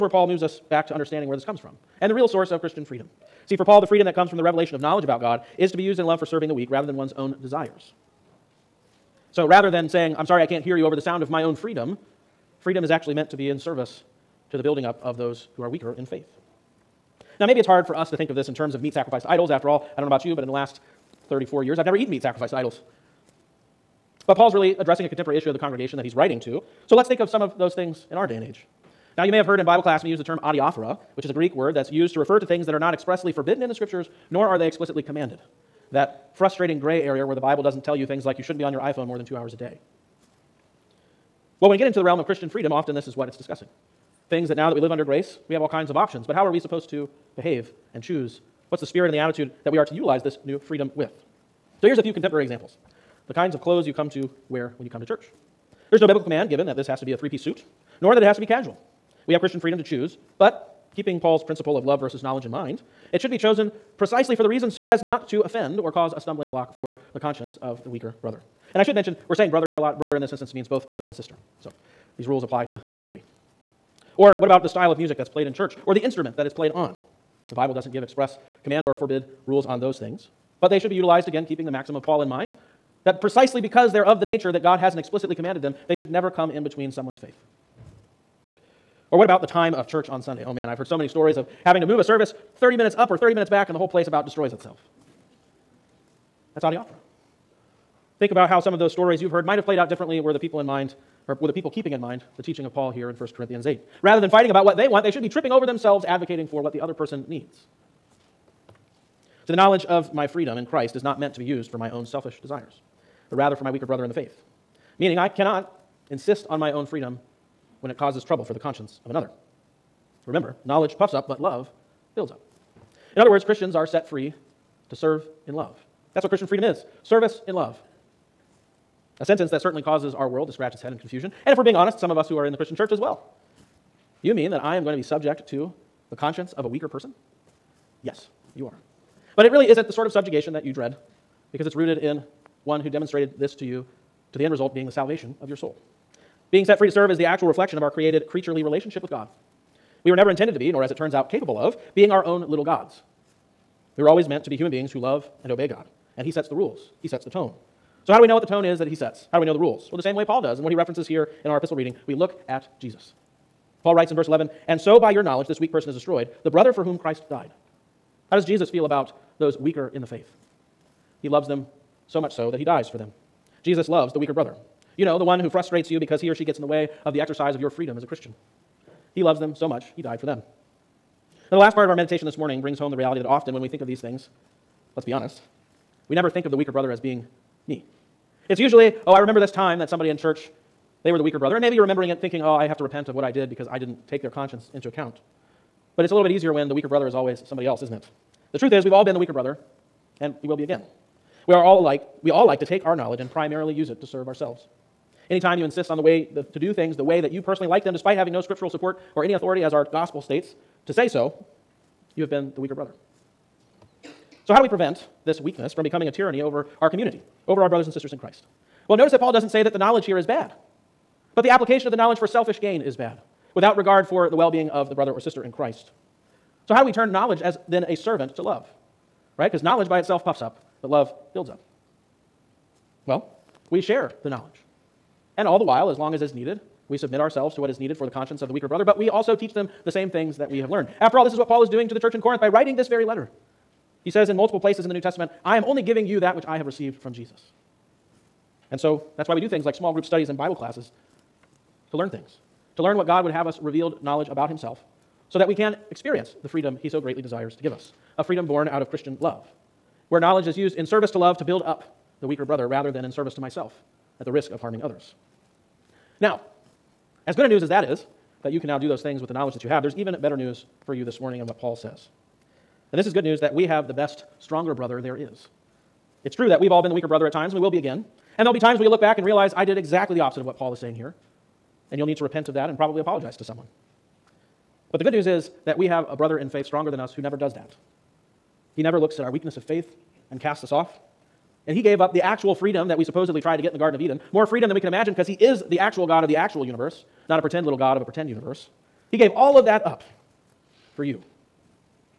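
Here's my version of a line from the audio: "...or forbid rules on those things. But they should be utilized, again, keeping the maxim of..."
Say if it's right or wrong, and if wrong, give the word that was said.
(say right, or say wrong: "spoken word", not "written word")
right.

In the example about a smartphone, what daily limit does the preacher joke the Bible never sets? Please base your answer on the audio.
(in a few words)
2 hours.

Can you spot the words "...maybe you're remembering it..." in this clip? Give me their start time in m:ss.
3:11.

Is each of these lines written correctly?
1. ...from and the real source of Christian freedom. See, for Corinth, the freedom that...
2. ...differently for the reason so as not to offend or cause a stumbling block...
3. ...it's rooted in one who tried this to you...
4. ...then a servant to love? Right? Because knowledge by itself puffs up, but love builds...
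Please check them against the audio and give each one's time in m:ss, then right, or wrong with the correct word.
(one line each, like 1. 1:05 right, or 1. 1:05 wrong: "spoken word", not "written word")
1. 0:01 wrong: "Paul", not "Corinth"
2. 1:03 wrong: "precisely", not "differently"
3. 2:21 wrong: "demonstrated", not "tried"
4. 3:47 right.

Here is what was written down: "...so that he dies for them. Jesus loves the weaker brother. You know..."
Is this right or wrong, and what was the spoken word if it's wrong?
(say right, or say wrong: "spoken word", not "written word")
right.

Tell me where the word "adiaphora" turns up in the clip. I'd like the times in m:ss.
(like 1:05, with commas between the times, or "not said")
0:30, 1:36.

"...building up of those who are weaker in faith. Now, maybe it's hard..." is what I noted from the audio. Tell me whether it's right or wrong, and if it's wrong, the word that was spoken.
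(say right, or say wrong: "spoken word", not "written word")
right.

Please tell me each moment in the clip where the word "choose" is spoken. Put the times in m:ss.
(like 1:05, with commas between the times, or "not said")
0:48, 0:59.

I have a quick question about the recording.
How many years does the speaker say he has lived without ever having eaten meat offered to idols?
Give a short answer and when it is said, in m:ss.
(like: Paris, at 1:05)
34, at 0:21.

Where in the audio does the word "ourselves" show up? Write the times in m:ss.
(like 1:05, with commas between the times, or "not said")
3:24, 3:57.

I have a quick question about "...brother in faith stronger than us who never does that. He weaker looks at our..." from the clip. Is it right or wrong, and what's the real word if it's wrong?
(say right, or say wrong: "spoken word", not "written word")
wrong: "never", not "weaker".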